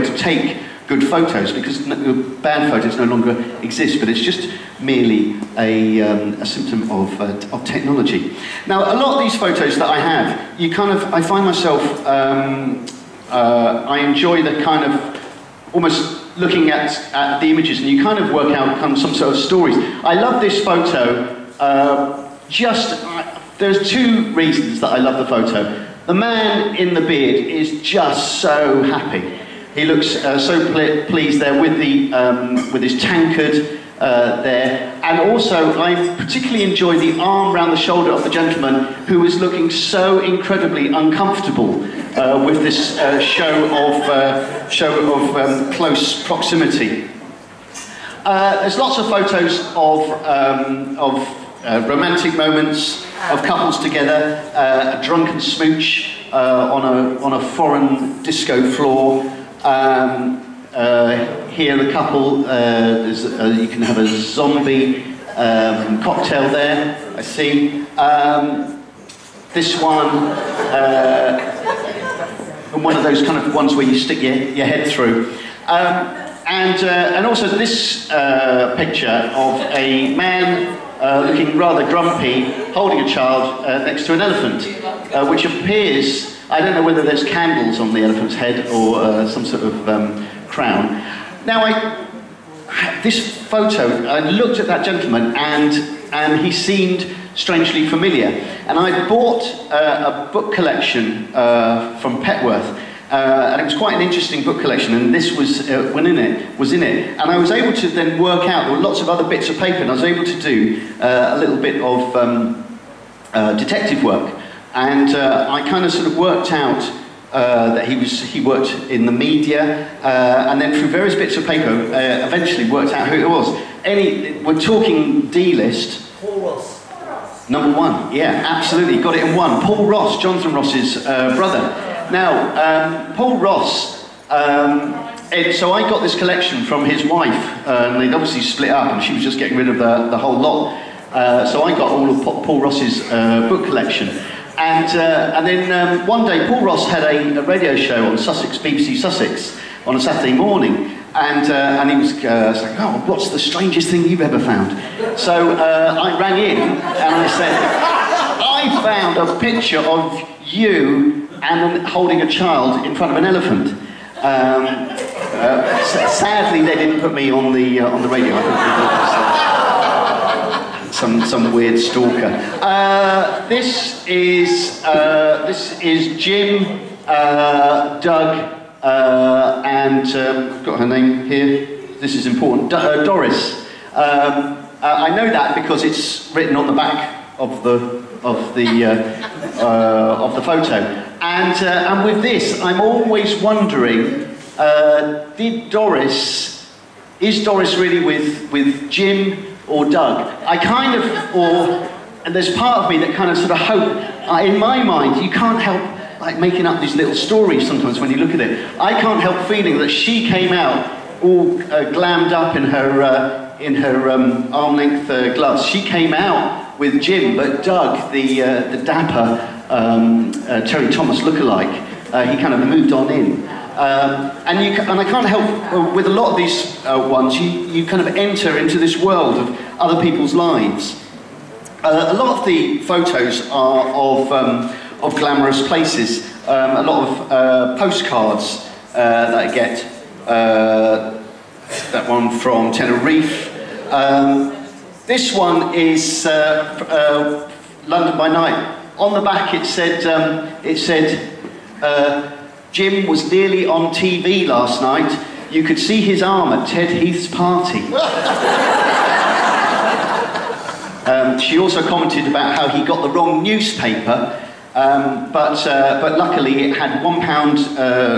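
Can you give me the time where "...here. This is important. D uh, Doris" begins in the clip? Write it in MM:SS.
03:01.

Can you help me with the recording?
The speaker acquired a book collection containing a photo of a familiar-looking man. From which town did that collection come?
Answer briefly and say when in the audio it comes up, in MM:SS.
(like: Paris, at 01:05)
Petworth, at 01:42.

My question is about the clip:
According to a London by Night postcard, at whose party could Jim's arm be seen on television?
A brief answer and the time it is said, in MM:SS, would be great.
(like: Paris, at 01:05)
Ted Heath, at 04:16.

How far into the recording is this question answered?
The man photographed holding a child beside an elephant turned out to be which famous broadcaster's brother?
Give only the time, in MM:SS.
02:10.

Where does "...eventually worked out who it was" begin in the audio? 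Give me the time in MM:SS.
02:02.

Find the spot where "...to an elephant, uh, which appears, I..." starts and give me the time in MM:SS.
01:24.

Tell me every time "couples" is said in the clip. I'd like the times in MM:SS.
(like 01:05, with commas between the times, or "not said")
00:53, 01:01.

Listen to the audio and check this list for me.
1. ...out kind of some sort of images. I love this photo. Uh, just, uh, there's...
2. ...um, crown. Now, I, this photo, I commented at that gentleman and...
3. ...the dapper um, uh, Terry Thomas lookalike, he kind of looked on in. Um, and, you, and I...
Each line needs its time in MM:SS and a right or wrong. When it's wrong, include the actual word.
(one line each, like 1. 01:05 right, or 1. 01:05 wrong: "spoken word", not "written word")
1. 00:18 wrong: "stories", not "images"
2. 01:29 wrong: "looked", not "commented"
3. 03:38 wrong: "moved", not "looked".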